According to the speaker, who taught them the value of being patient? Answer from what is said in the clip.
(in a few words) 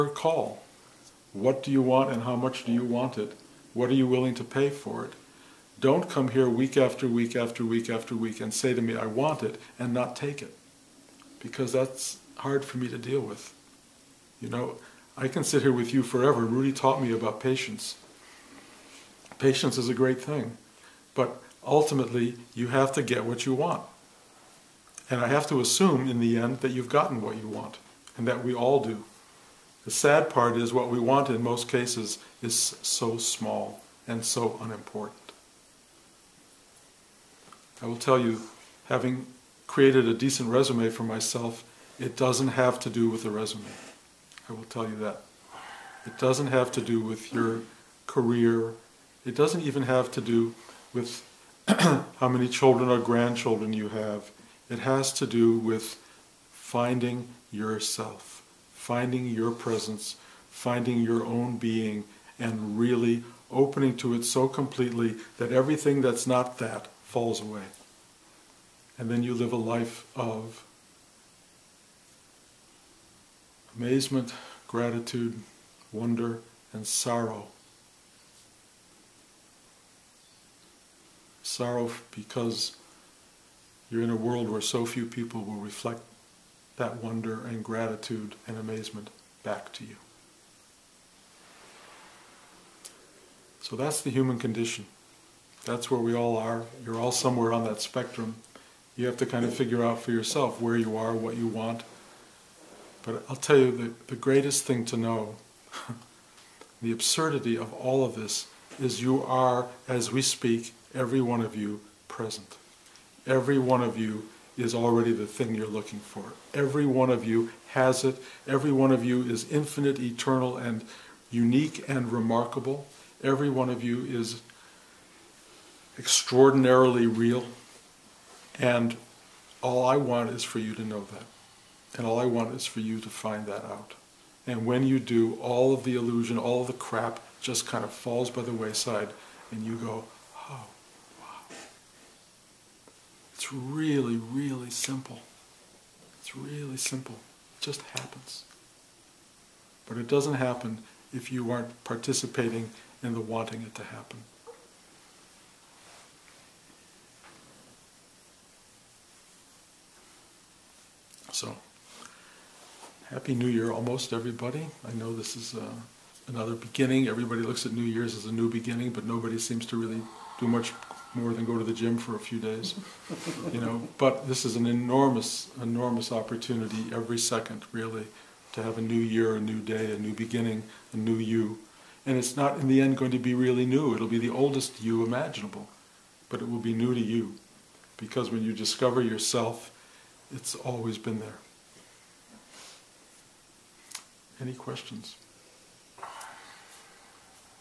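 Rudi.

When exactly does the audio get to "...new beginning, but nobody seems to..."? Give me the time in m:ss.
2:48.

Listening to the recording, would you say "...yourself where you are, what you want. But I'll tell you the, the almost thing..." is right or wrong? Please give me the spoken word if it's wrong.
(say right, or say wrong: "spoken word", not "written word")
wrong: "greatest", not "almost".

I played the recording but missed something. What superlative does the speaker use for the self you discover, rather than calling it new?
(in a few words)
oldest.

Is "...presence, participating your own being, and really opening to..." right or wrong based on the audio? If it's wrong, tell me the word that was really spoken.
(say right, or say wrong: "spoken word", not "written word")
wrong: "finding", not "participating".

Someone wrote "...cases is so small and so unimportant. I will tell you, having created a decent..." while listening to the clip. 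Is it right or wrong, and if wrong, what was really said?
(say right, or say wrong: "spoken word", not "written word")
right.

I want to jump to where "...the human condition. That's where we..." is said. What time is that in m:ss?
1:34.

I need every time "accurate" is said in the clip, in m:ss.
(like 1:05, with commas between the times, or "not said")
not said.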